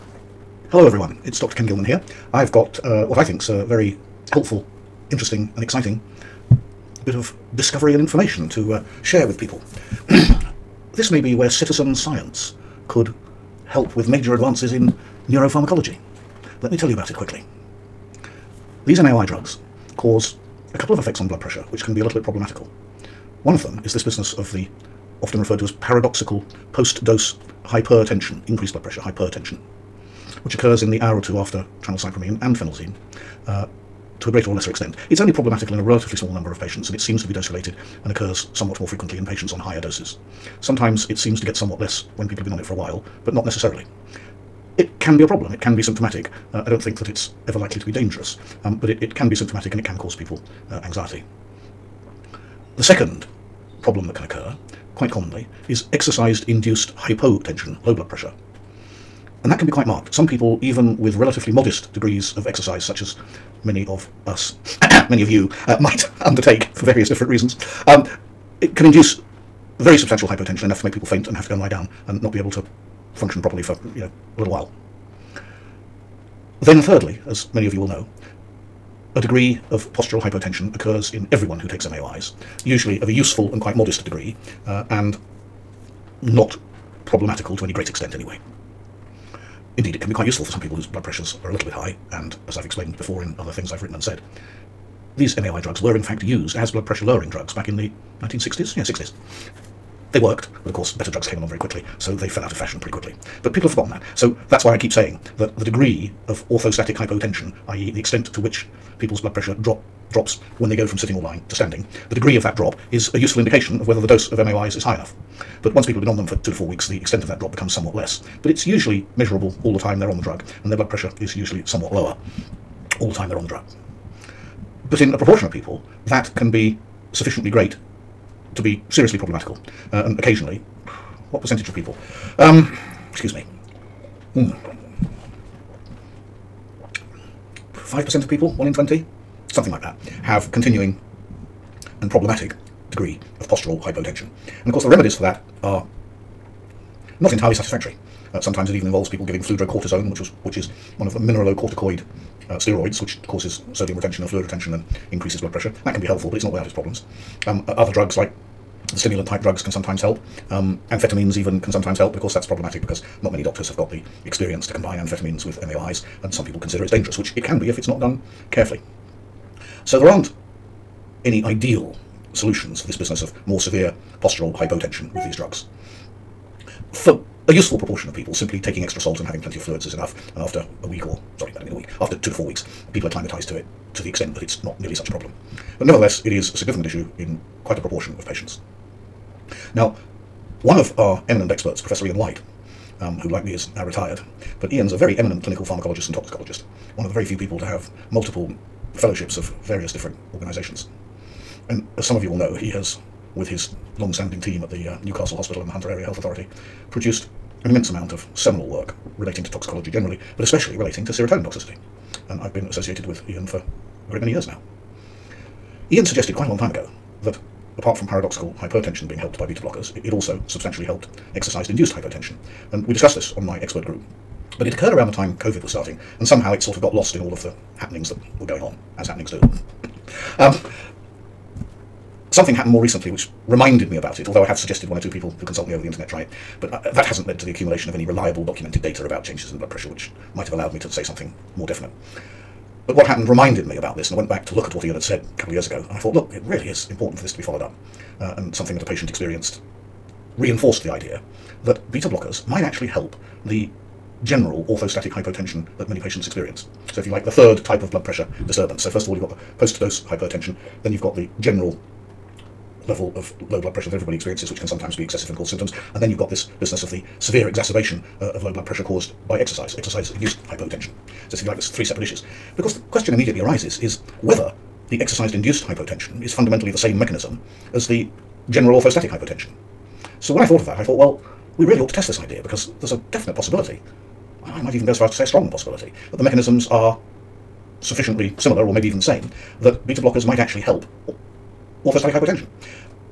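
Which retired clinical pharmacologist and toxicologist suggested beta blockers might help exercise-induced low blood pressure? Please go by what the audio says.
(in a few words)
Ian Whyte.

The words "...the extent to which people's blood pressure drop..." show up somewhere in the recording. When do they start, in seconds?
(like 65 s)
107 s.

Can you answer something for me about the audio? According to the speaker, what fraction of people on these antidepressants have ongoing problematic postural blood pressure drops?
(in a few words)
1 in 20.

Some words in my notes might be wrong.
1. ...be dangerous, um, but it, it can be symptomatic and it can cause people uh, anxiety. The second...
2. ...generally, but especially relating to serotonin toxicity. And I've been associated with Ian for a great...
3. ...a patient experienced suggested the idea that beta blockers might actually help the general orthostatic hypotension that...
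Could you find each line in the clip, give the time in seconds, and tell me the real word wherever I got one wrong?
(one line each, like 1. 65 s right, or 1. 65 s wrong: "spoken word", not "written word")
1. 47 s right
2. 209 s right
3. 248 s wrong: "reinforced", not "suggested".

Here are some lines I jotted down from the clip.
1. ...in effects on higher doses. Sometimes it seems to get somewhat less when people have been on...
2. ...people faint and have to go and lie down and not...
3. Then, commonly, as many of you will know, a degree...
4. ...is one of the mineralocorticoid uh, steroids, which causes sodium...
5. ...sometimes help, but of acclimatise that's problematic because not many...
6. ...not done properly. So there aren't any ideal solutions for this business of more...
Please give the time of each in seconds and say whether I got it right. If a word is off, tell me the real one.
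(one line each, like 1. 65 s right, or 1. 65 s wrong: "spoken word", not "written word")
1. 39 s wrong: "patients", not "effects"
2. 70 s right
3. 76 s wrong: "thirdly", not "commonly"
4. 150 s right
5. 161 s wrong: "course", not "acclimatise"
6. 167 s wrong: "carefully", not "properly".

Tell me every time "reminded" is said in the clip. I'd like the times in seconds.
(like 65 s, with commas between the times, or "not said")
233 s, 243 s.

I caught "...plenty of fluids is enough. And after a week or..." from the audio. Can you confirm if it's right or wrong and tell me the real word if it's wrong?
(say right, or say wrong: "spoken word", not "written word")
right.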